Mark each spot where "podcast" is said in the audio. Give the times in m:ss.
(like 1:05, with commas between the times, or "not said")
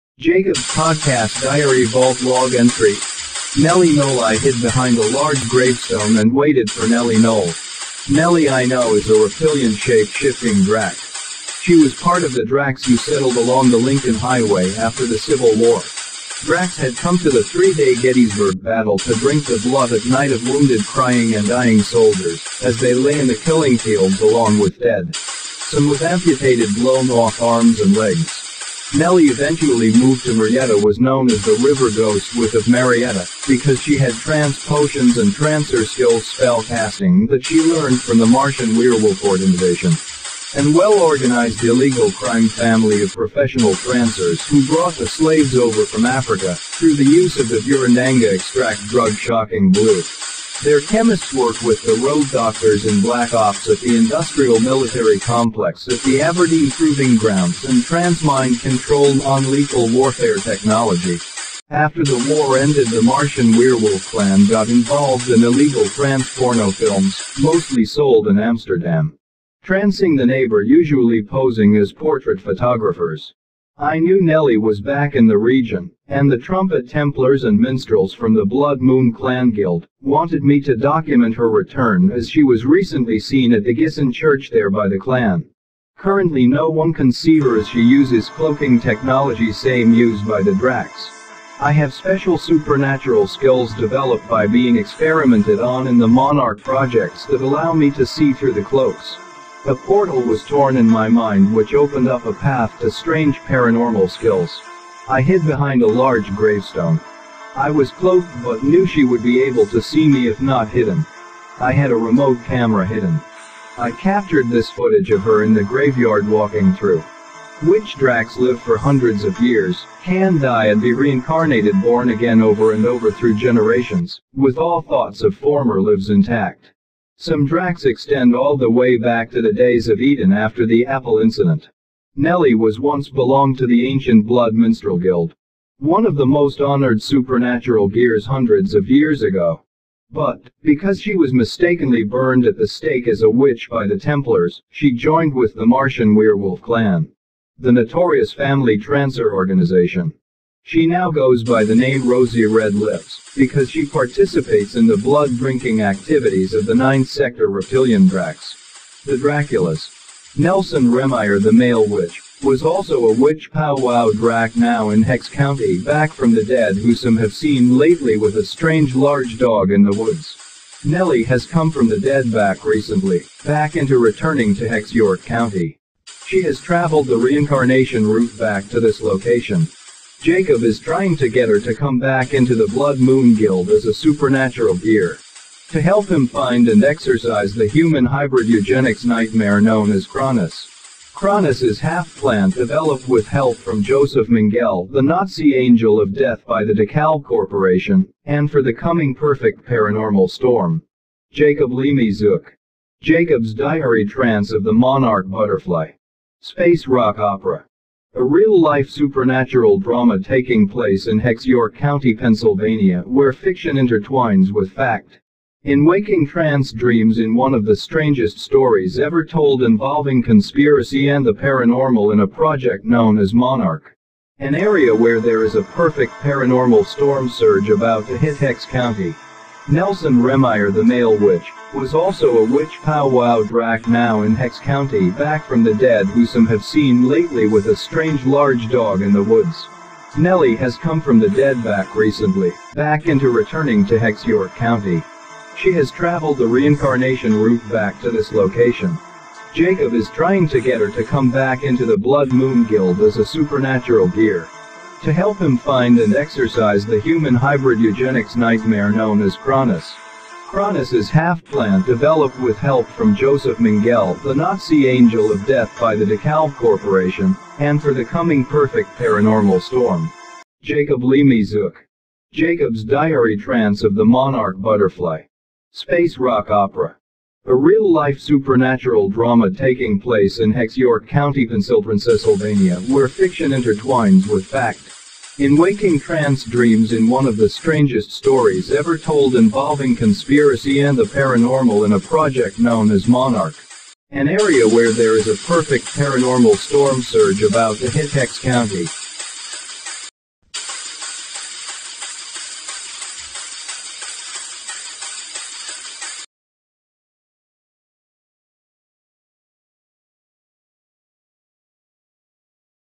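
0:00.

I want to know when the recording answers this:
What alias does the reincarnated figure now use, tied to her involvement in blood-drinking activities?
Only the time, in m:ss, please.
2:32.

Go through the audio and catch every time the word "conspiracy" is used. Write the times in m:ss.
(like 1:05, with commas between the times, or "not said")
3:40, 4:49.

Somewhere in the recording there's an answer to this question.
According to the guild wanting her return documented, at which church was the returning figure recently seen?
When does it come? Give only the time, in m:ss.
1:23.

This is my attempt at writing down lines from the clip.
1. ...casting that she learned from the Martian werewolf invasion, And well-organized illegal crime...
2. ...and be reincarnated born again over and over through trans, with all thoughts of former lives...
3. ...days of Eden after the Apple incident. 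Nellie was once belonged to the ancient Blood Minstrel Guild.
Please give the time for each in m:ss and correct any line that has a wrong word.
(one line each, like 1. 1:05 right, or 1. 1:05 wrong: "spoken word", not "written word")
1. 0:36 right
2. 2:00 wrong: "generations", not "trans"
3. 2:09 right.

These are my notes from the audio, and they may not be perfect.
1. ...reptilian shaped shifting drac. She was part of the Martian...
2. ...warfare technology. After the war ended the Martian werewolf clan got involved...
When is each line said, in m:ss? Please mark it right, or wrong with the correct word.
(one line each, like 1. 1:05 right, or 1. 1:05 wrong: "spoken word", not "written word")
1. 0:09 wrong: "Dracs", not "Martian"
2. 0:59 right.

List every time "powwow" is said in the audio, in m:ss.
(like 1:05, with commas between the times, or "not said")
2:43, 3:52.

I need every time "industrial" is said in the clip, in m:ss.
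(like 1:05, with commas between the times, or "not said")
0:53.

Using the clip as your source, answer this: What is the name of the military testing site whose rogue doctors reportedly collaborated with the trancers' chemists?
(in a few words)
Aberdeen Proving Grounds.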